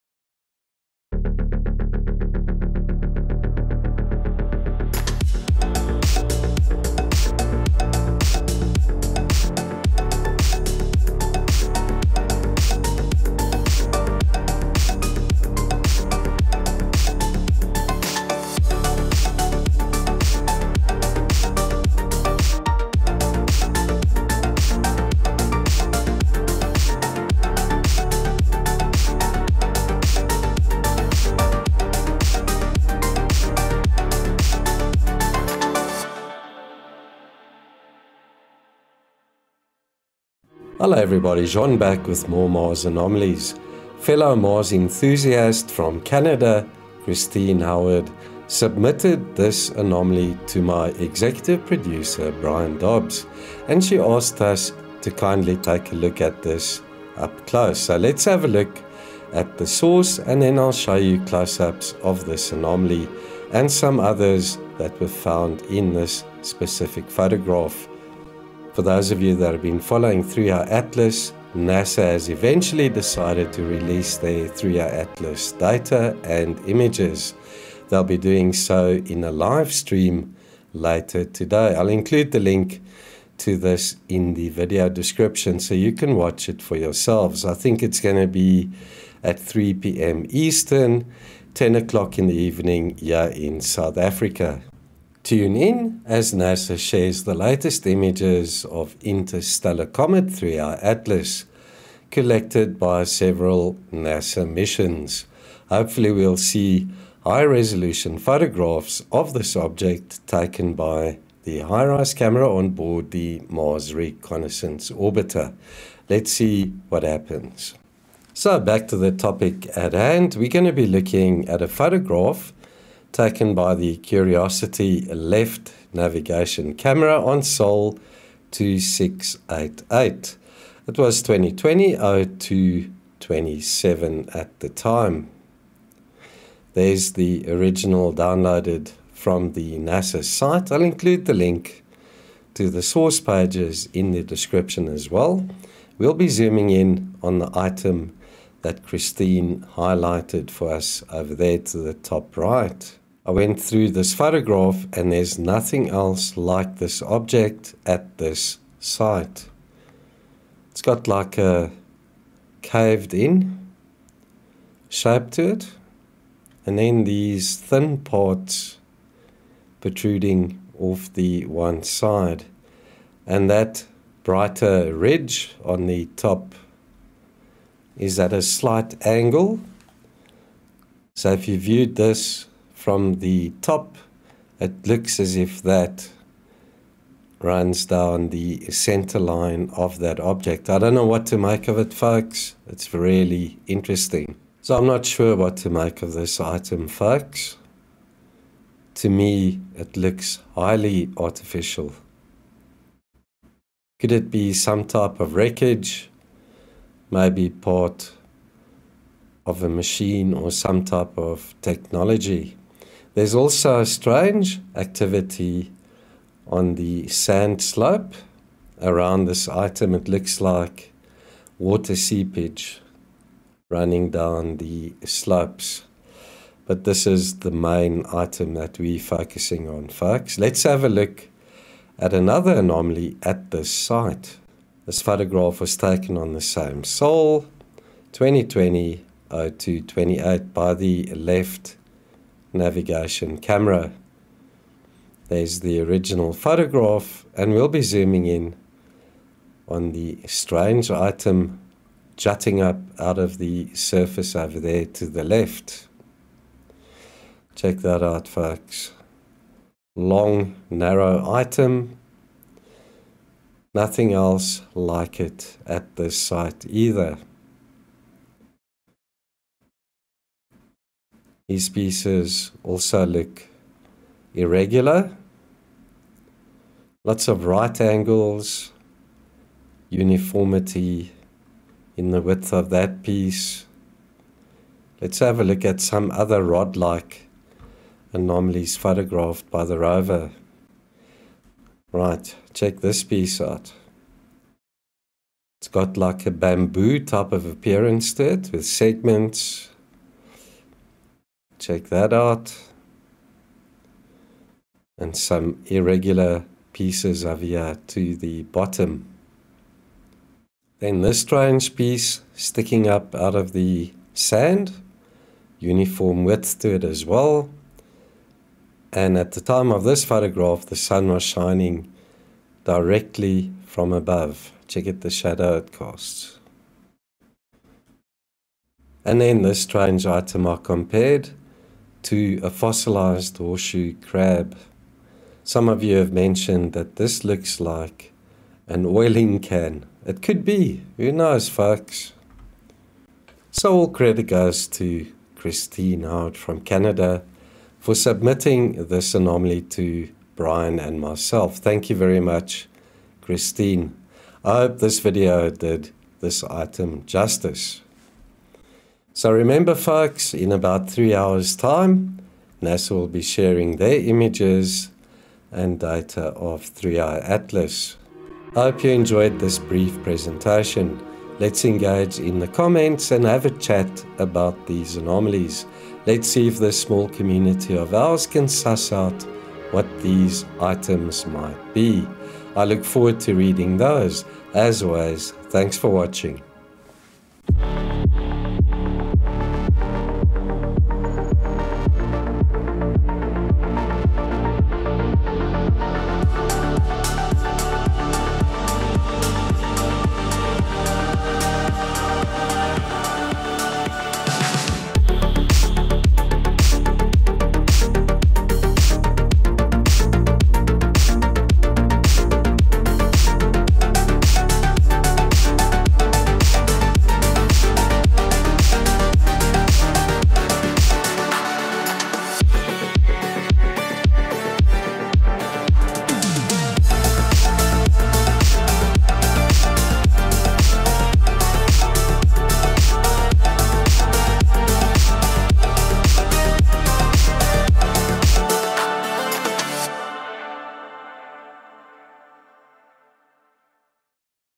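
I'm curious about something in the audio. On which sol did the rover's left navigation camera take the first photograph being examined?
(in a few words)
Sol 2688.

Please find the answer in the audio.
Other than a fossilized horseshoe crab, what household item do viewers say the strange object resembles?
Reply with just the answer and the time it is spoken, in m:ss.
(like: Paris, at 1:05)
An oiling can, at 5:38.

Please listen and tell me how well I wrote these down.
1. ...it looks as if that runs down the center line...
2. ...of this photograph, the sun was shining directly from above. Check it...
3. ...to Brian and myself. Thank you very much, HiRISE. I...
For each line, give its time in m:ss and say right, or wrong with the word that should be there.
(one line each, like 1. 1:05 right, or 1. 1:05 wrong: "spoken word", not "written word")
1. 3:04 right
2. 5:19 right
3. 5:49 wrong: "Christine", not "HiRISE".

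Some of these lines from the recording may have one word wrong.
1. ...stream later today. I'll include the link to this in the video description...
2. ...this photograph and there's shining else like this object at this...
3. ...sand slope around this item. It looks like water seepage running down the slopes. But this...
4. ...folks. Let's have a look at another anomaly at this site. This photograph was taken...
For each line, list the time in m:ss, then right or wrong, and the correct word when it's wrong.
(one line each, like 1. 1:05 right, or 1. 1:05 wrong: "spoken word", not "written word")
1. 1:19 right
2. 2:33 wrong: "nothing", not "shining"
3. 3:37 right
4. 3:49 right.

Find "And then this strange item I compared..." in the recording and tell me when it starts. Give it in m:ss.
5:29.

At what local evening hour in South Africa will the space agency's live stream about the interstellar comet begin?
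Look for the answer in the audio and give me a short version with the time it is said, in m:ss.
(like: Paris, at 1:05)
10 o'clock, at 1:31.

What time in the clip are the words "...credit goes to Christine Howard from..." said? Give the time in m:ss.
5:43.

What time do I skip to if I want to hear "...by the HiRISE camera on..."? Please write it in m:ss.
1:50.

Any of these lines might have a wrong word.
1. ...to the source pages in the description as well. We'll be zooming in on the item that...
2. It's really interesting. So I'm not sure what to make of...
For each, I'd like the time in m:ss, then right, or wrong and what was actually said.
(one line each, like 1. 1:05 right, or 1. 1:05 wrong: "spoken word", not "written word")
1. 2:22 right
2. 3:12 right.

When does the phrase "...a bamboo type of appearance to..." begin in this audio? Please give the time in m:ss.
4:56.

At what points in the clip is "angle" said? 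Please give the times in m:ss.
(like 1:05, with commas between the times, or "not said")
2:59, 4:37.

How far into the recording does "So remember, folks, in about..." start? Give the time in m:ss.
5:59.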